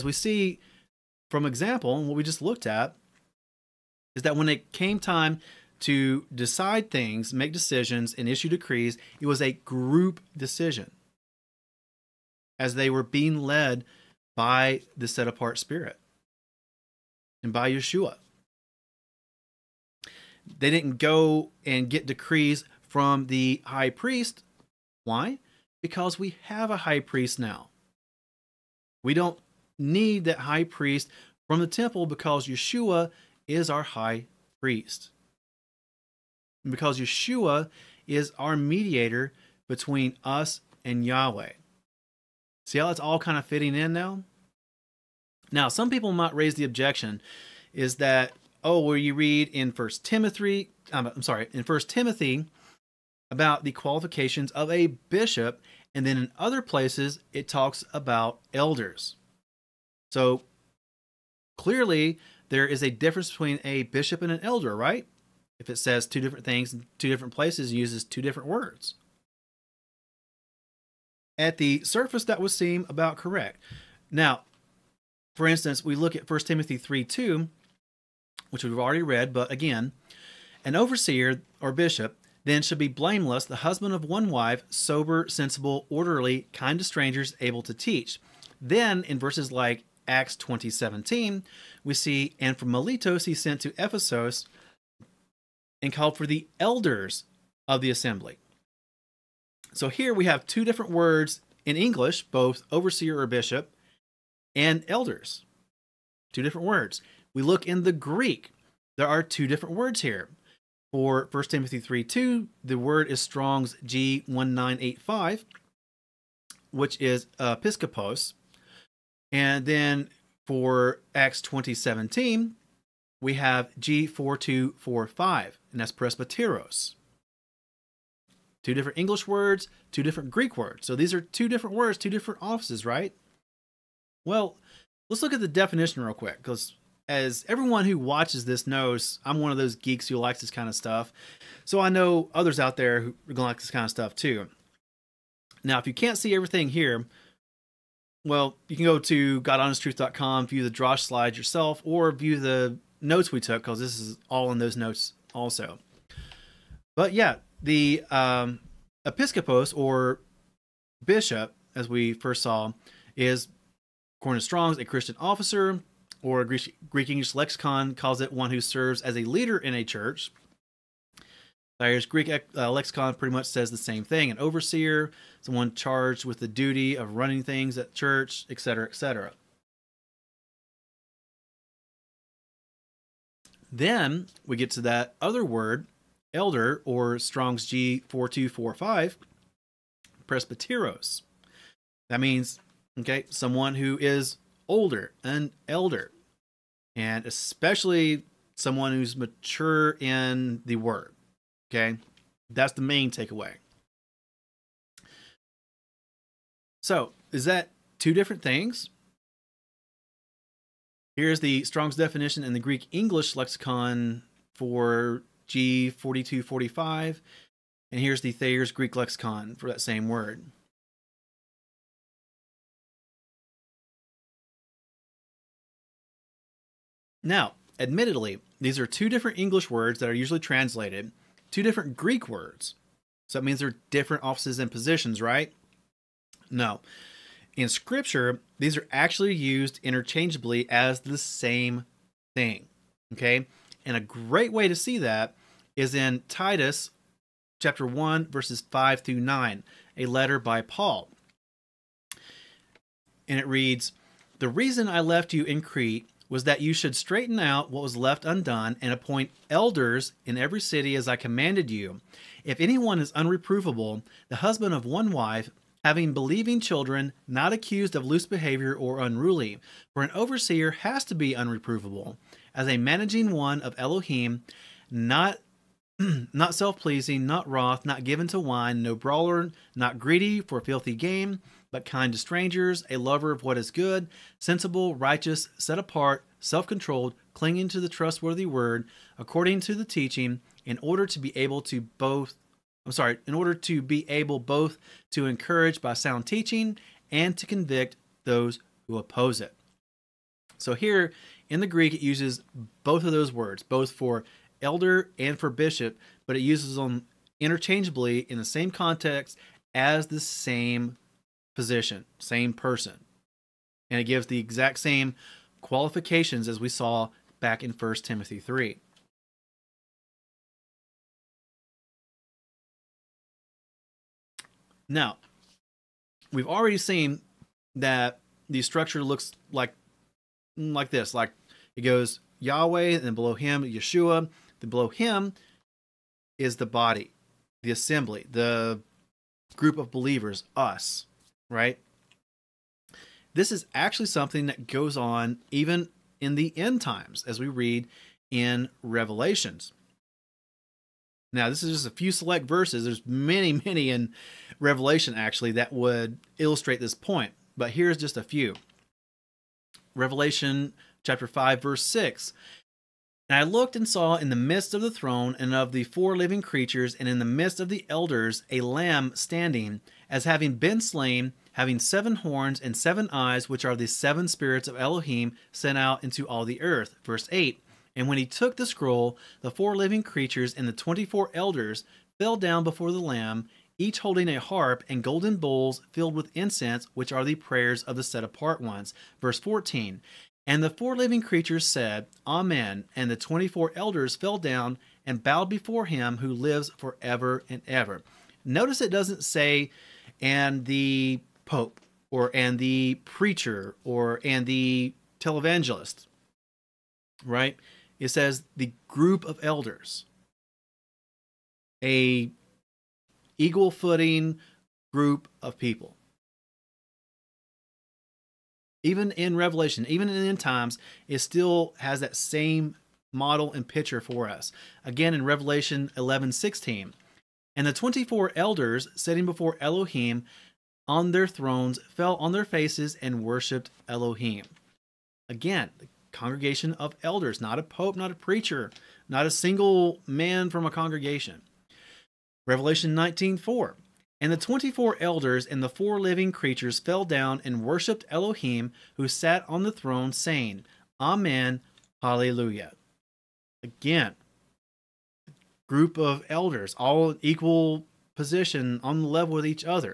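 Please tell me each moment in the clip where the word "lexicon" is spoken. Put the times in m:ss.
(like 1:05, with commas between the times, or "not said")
2:47, 2:52, 3:33, 3:38.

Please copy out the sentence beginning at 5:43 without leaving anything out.
This is actually something that goes on even in the end times, as we read in Revelations.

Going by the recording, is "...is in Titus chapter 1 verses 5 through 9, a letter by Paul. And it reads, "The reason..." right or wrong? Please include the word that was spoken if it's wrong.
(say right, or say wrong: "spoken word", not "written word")
right.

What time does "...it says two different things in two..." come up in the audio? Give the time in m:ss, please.
1:05.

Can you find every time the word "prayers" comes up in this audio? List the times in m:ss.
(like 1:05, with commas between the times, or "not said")
6:27.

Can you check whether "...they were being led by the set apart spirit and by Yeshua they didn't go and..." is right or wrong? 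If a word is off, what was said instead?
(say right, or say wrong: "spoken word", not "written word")
right.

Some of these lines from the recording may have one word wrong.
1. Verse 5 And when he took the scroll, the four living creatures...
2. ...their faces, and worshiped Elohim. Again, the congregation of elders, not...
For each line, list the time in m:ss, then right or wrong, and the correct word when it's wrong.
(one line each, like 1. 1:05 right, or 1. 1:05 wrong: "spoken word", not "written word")
1. 6:17 wrong: "8", not "5"
2. 7:12 right.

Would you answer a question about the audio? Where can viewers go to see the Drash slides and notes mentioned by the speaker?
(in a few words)
GodHonestTruth.com.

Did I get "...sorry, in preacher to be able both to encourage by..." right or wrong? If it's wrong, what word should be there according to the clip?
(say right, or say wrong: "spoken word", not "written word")
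wrong: "order", not "preacher".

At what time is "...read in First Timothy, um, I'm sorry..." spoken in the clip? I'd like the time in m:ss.
0:49.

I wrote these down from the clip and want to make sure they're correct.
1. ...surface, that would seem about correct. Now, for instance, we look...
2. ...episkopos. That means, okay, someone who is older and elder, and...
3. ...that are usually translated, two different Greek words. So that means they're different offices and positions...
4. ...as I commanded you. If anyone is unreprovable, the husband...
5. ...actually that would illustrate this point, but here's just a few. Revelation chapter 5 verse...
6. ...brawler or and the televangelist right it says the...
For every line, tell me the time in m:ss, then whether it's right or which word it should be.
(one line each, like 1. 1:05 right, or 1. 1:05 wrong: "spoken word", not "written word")
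1. 1:11 right
2. 3:10 wrong: "presbyteros", not "episkopos"
3. 3:49 right
4. 4:20 right
5. 5:55 right
6. 6:43 wrong: "preacher", not "brawler".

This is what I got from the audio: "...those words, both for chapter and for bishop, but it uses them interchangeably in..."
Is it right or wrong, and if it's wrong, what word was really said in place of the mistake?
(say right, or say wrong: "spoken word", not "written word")
wrong: "elder", not "chapter".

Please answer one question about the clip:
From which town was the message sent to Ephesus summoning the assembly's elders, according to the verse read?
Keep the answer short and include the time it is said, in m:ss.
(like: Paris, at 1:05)
Miletos, at 1:32.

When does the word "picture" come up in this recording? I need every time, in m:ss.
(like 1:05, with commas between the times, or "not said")
7:03.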